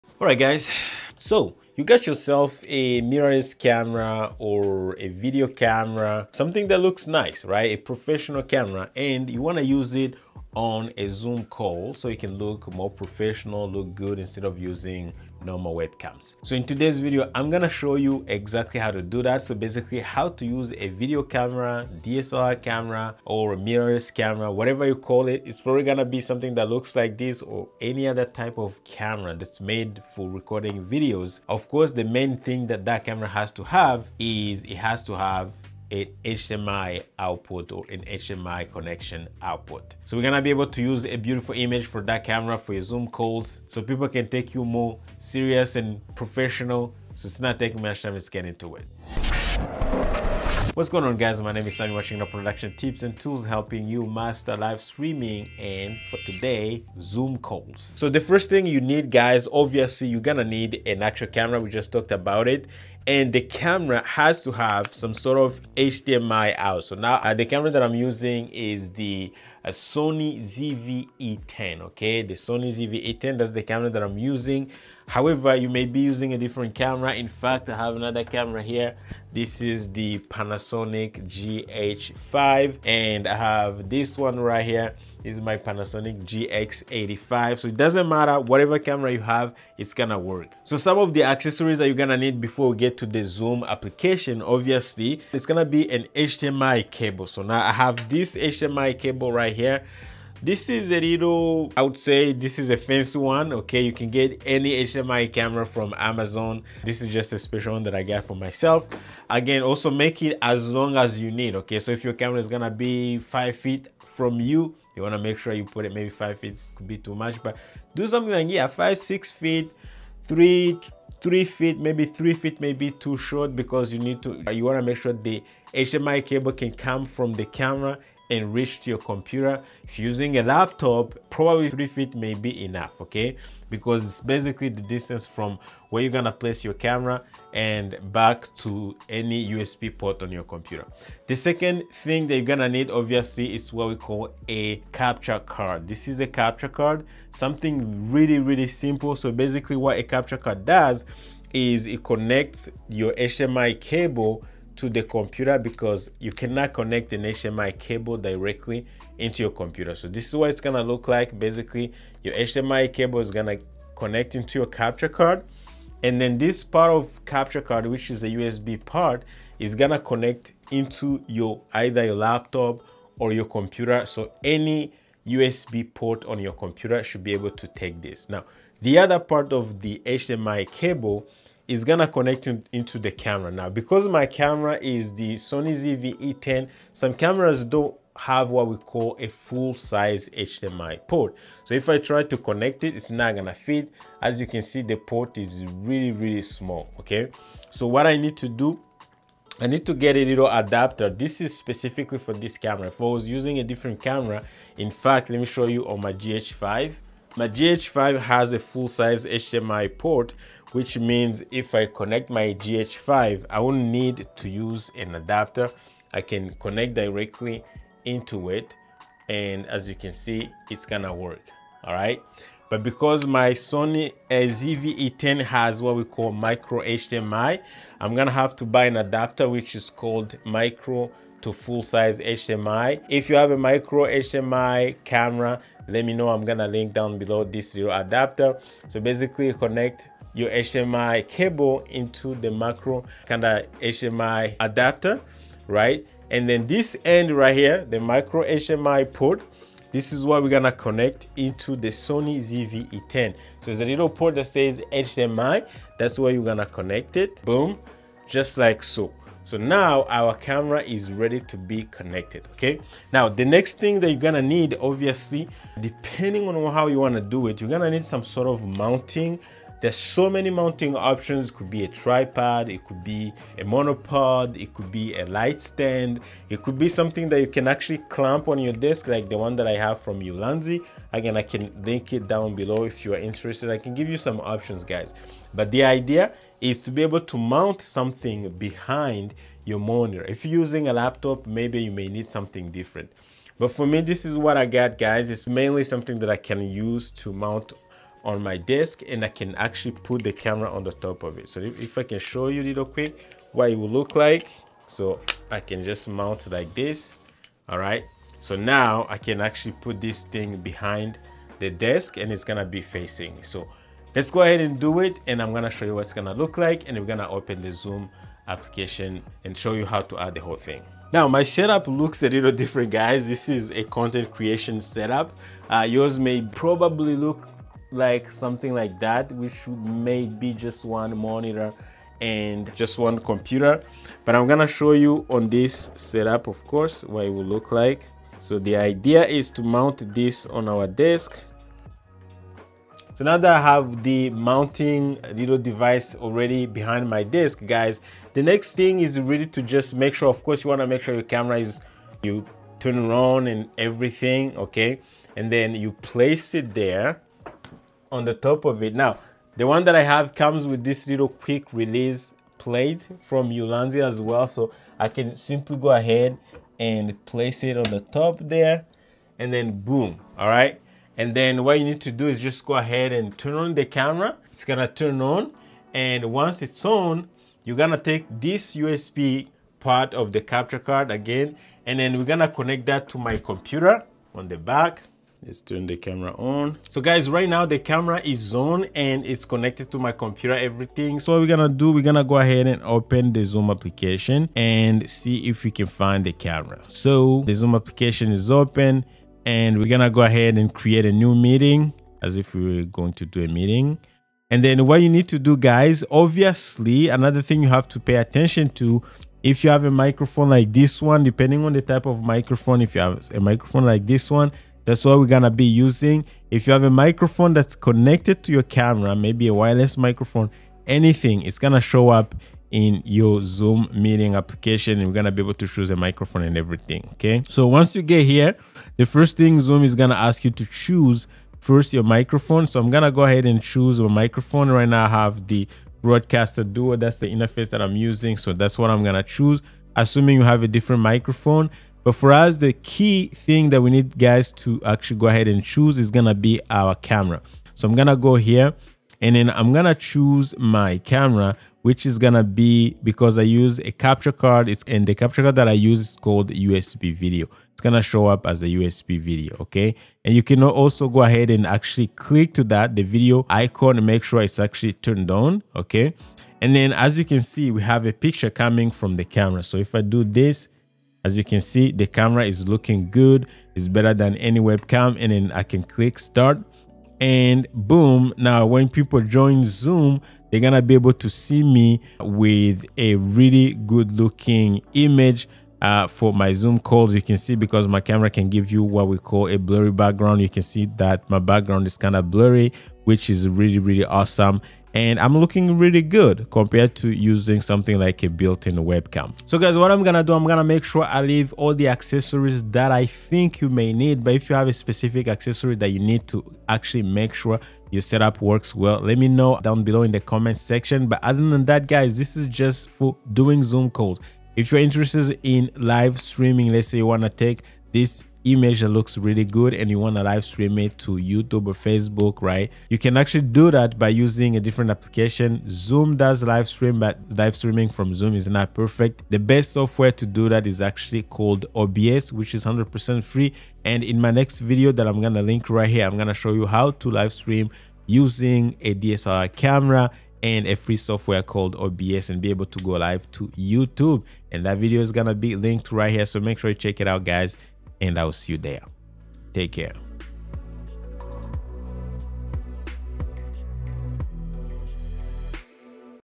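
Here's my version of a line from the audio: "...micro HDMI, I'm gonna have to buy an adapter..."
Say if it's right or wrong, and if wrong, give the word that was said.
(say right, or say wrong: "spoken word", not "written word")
right.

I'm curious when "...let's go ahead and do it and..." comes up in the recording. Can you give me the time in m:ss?
5:14.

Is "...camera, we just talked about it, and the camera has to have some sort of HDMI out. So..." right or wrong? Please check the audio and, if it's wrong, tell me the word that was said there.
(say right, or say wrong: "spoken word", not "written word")
right.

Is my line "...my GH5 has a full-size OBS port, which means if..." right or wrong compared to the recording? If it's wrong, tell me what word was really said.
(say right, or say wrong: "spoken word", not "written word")
wrong: "HDMI", not "OBS".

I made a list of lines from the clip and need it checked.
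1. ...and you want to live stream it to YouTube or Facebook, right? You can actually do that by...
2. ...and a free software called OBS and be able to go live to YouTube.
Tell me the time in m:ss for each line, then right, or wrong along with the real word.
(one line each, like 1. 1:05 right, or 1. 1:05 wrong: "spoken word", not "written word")
1. 8:39 right
2. 9:00 right.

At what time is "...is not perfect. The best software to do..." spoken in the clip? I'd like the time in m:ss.
8:48.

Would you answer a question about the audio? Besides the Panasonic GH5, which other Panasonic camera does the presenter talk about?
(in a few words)
Panasonic GX85.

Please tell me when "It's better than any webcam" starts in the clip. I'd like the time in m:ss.
7:53.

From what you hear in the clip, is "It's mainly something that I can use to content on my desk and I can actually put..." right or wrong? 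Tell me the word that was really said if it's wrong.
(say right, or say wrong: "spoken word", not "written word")
wrong: "mount", not "content".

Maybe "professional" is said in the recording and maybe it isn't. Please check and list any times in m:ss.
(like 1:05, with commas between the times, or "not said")
0:07, 0:12, 0:46.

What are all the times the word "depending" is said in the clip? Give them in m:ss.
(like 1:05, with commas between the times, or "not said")
4:25, 6:51.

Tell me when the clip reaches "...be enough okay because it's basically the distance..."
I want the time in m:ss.
2:12.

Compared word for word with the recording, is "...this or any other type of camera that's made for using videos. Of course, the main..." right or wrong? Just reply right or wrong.
wrong.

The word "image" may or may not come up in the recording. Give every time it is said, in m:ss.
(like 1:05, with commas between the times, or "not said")
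0:41, 8:04, 8:38.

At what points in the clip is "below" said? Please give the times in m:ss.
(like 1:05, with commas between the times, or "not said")
3:57, 4:42, 8:29.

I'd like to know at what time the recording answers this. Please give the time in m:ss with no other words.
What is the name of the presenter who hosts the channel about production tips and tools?
0:51.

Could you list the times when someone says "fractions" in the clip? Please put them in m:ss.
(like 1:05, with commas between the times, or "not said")
not said.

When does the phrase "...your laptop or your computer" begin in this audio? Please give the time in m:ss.
2:52.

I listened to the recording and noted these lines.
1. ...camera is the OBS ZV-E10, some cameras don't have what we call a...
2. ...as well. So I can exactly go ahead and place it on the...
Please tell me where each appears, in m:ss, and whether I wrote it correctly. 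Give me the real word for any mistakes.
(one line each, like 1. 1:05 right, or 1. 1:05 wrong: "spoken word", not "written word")
1. 3:04 wrong: "Sony", not "OBS"
2. 6:04 wrong: "simply", not "exactly".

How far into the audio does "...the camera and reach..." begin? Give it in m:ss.
2:07.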